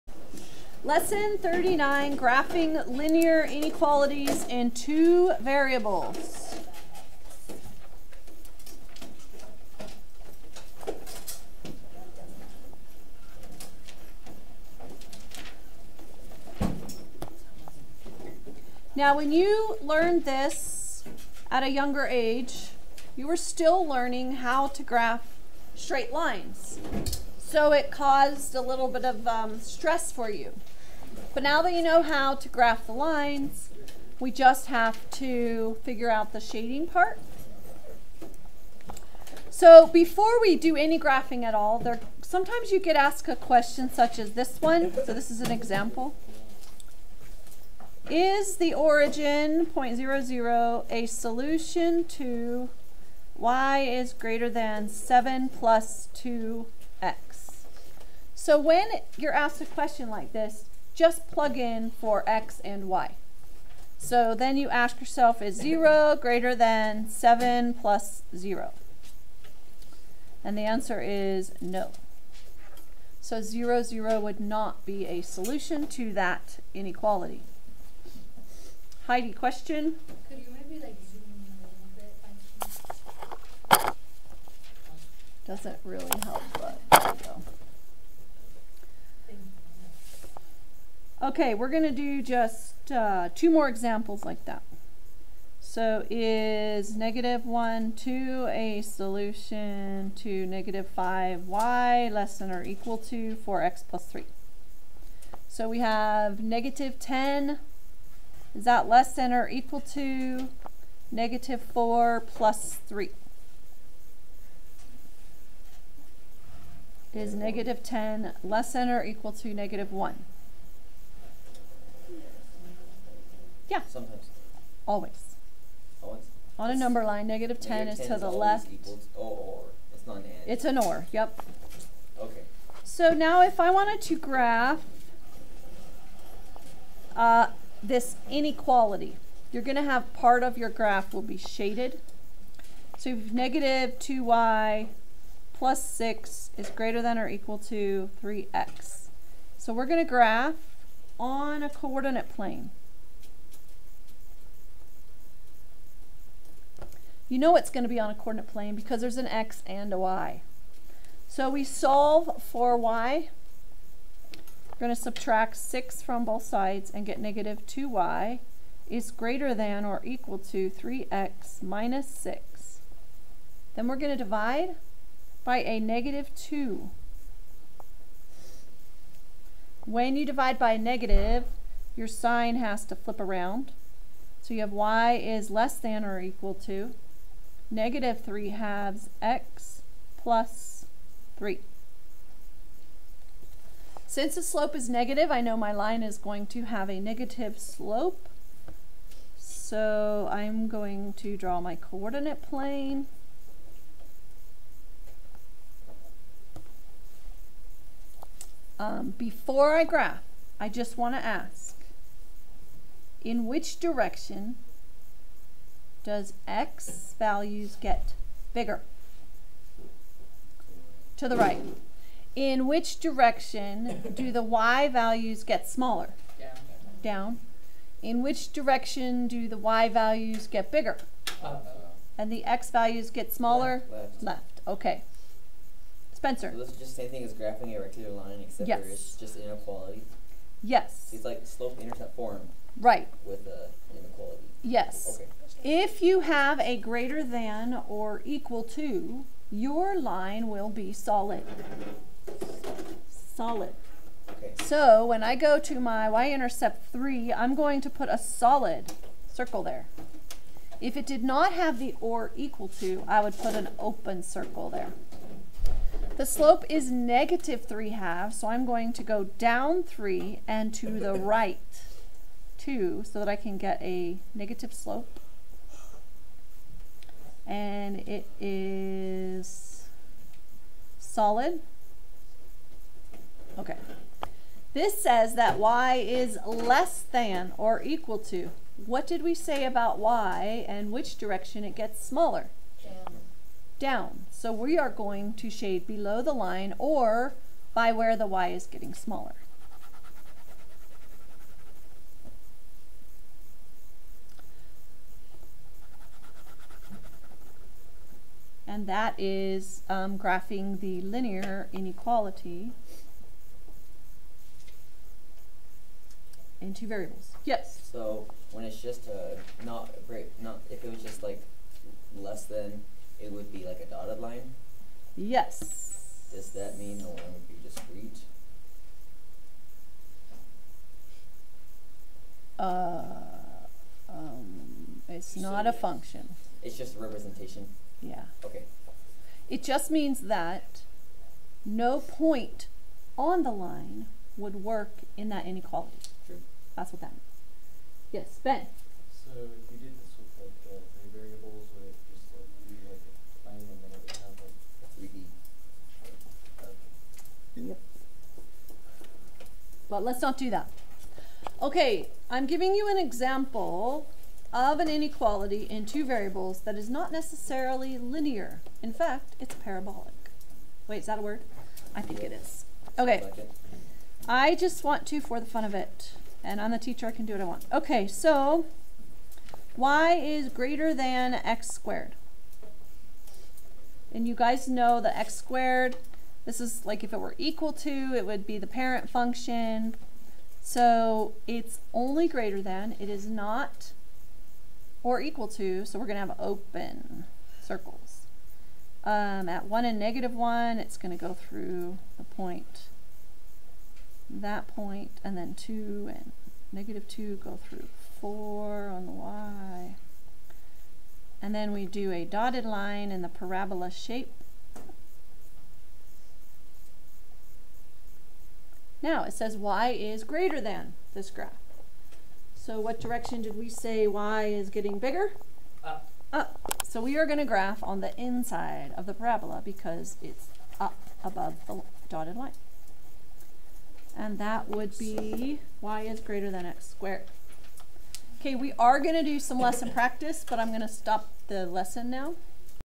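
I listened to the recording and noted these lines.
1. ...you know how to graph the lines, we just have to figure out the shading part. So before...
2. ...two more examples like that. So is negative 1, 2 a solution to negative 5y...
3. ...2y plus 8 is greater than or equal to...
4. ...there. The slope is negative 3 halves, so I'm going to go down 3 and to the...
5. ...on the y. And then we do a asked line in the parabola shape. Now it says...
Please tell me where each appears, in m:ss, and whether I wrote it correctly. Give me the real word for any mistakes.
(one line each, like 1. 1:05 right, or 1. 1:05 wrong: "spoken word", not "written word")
1. 0:31 right
2. 1:33 right
3. 2:23 wrong: "6", not "8"
4. 4:24 right
5. 6:48 wrong: "dotted", not "asked".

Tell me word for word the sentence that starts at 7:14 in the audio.
And that would be y is greater than x squared.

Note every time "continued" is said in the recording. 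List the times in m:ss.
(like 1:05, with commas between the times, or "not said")
not said.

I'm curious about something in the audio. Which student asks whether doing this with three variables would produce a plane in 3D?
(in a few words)
Ben.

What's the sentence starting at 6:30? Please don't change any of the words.
So it's only greater than, it is not or equal to, so we're going to have open circles.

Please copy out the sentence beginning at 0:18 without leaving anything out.
Now, when you learned this at a younger age, you were still learning how to graph straight lines.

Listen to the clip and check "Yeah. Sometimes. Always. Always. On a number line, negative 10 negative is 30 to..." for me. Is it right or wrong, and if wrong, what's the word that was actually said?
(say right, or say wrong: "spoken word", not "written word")
wrong: "10", not "30".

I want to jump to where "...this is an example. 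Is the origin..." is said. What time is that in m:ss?
0:45.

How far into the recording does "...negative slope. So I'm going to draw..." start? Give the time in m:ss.
3:16.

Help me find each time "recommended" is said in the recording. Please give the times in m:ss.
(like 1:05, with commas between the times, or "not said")
not said.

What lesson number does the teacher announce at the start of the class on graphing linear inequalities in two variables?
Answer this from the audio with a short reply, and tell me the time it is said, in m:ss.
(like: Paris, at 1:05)
39, at 0:00.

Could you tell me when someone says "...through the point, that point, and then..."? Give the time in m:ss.
6:41.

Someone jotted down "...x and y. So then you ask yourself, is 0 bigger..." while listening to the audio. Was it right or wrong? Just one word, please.
wrong.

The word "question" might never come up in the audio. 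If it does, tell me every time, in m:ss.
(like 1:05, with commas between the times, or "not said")
0:43, 0:59, 1:19.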